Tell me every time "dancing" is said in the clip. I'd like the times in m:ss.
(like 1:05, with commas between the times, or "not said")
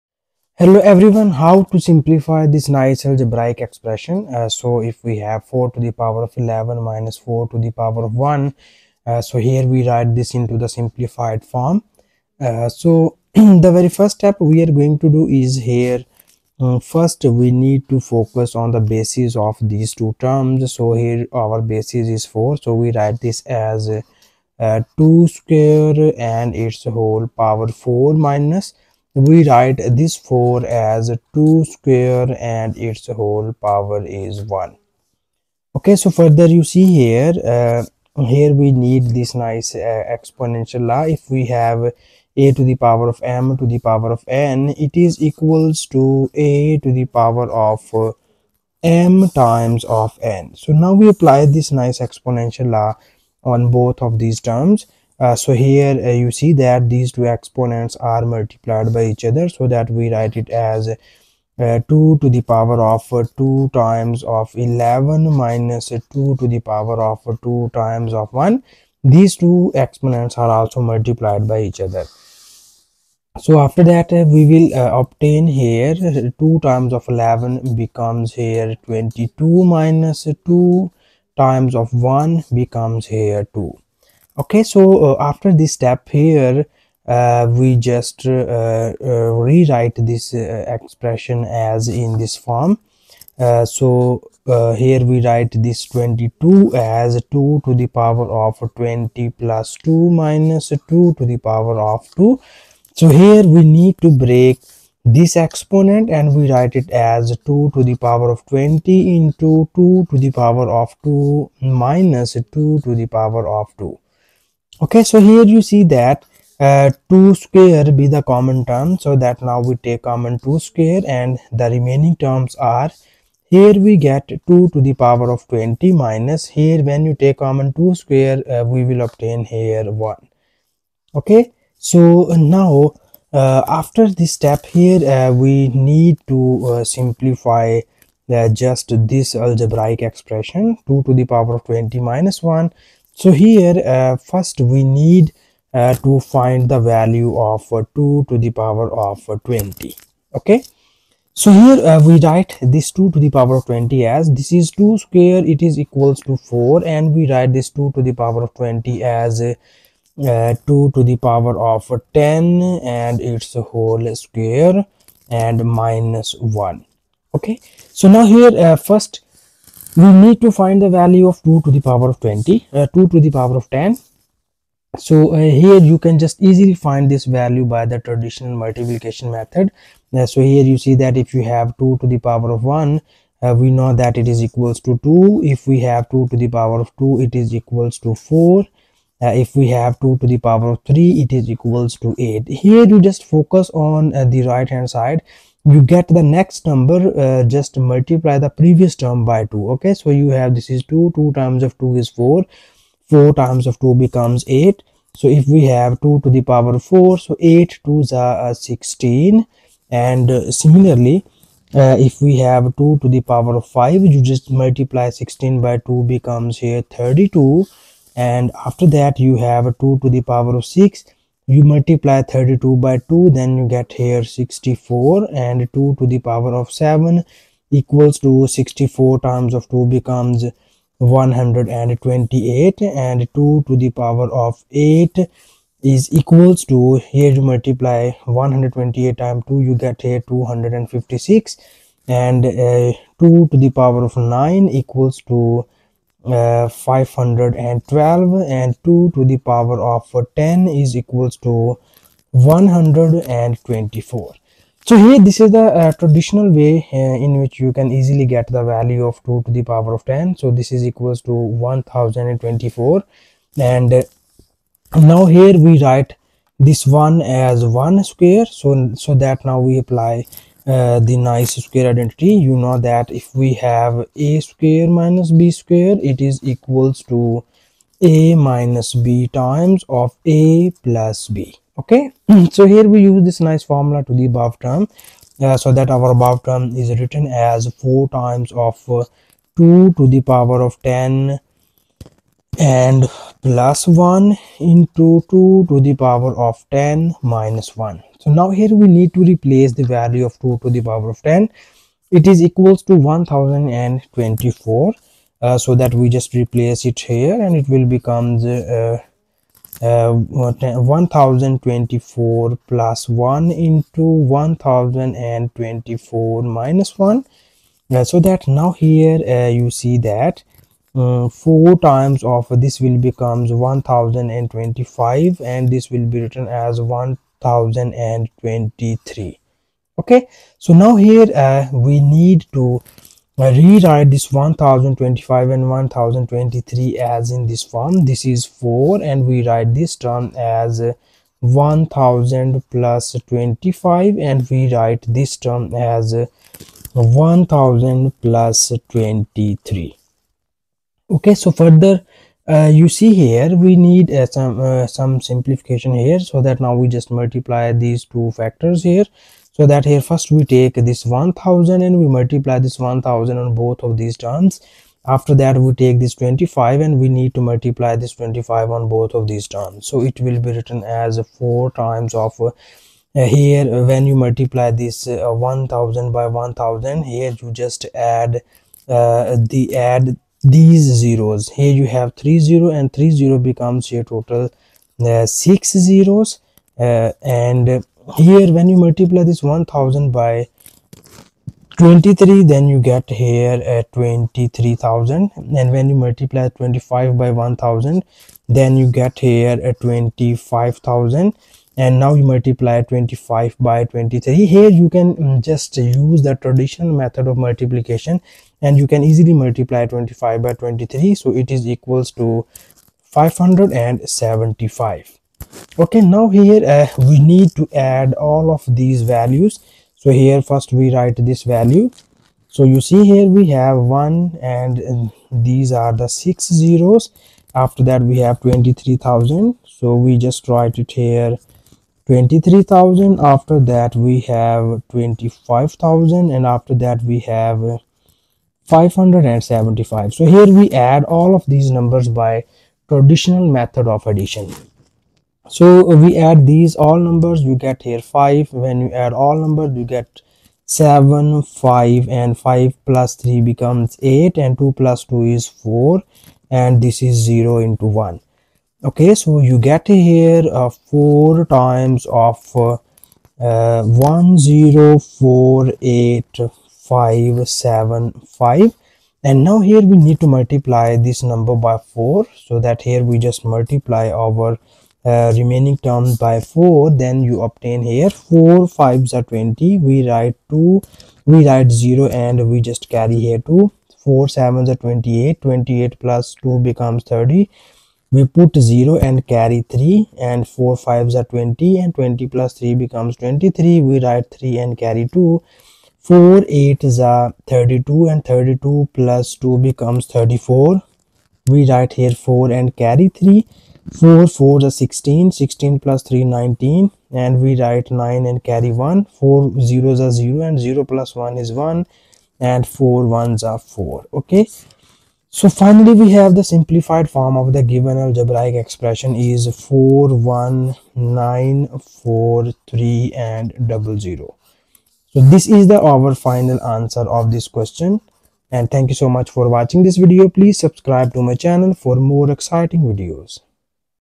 not said.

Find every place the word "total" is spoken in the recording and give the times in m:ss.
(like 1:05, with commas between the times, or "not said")
6:24.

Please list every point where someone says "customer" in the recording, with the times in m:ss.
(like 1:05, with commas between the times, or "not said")
not said.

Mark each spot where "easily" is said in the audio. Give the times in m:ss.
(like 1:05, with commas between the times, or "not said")
2:56, 4:17, 6:49.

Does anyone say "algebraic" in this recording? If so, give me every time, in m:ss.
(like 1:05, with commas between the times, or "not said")
0:03, 2:19, 8:37.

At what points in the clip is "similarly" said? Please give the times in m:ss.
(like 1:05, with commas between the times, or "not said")
3:30.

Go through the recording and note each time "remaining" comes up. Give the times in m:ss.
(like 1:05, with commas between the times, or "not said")
2:01, 7:55.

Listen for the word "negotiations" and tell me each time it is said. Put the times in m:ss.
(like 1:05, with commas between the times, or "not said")
not said.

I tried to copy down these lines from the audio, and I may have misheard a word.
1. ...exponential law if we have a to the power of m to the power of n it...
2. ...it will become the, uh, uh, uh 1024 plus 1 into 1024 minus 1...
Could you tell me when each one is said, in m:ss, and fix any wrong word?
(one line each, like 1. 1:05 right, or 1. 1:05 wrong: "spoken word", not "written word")
1. 0:40 right
2. 5:07 right.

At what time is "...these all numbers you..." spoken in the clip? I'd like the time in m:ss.
7:26.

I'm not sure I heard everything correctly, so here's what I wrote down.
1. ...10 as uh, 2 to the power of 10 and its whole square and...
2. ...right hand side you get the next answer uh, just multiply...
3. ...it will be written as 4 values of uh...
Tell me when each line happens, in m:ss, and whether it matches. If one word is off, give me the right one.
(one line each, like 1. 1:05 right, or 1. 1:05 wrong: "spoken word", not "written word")
1. 2:38 wrong: "20", not "10"
2. 3:14 wrong: "number", not "answer"
3. 6:10 wrong: "times", not "values".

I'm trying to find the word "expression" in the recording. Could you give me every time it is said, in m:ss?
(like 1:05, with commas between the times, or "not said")
0:03, 1:30, 2:20, 8:38.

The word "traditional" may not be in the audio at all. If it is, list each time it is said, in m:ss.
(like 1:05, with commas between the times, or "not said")
2:57, 4:15, 6:46, 7:22.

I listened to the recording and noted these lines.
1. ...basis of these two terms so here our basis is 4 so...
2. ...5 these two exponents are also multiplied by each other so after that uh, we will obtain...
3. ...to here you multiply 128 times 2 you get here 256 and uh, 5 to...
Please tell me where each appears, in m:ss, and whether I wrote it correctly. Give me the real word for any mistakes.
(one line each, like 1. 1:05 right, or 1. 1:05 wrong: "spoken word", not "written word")
1. 0:18 right
2. 1:08 wrong: "1", not "5"
3. 3:56 wrong: "2", not "5".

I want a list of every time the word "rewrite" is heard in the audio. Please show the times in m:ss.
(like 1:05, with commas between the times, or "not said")
1:29, 5:33.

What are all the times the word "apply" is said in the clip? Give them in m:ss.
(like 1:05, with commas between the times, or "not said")
0:51, 4:29.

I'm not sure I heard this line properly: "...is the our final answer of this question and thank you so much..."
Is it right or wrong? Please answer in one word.
right.